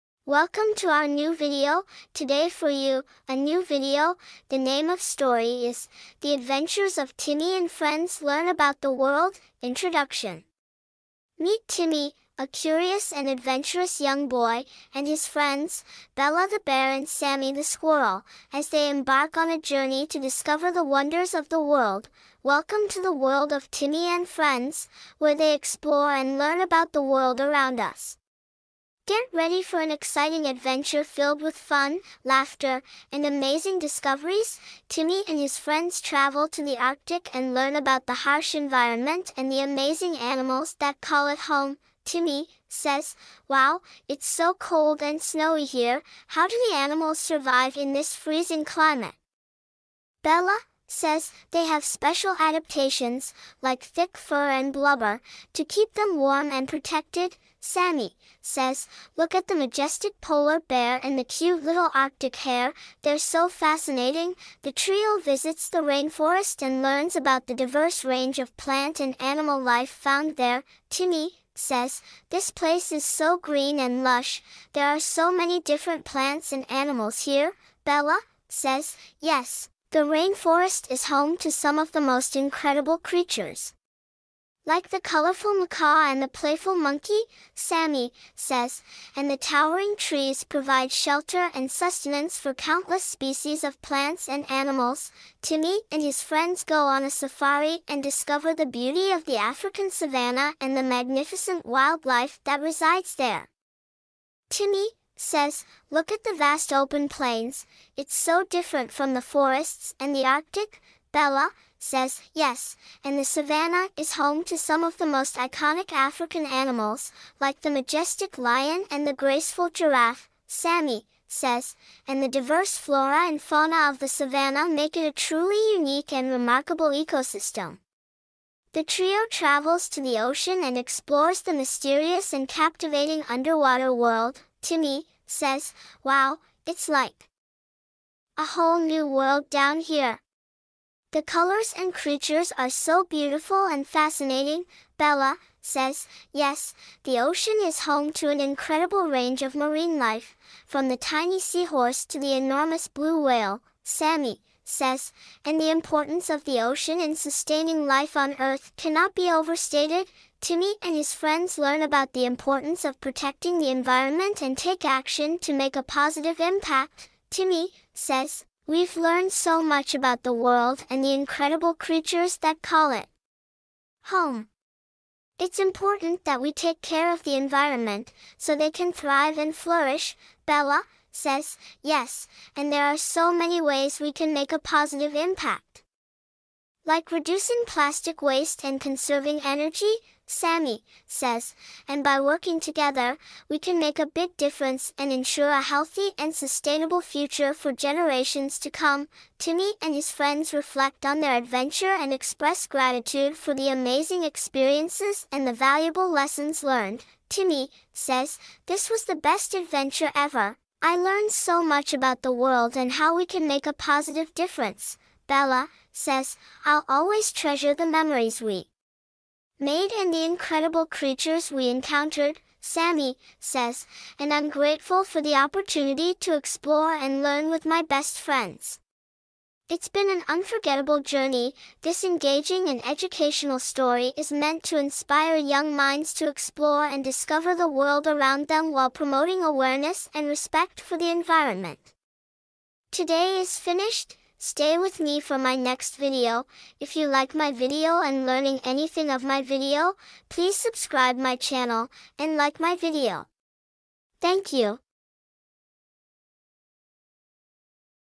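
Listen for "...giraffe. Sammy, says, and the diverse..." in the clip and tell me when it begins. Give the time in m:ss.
1:59.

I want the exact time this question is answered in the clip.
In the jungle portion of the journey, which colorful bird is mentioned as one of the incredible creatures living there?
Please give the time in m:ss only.
1:25.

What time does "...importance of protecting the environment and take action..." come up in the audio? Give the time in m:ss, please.
2:42.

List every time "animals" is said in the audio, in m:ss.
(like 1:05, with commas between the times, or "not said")
0:40, 0:46, 1:09, 1:16, 1:34, 1:56.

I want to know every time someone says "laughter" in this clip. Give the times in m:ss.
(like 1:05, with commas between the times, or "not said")
0:32.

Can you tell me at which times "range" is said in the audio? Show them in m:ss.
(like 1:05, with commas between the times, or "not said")
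1:08, 2:29.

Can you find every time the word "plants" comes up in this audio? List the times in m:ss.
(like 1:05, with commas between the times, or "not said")
1:08, 1:16, 1:33.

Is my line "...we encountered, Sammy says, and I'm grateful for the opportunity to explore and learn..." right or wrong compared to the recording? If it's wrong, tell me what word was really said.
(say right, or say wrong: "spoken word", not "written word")
right.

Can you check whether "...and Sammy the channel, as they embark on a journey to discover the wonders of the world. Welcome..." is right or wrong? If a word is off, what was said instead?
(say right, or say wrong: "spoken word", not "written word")
wrong: "squirrel", not "channel".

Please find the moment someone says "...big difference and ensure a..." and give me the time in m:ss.
3:14.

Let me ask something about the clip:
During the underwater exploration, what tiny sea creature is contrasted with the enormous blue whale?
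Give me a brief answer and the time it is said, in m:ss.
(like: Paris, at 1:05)
Seahorse, at 2:31.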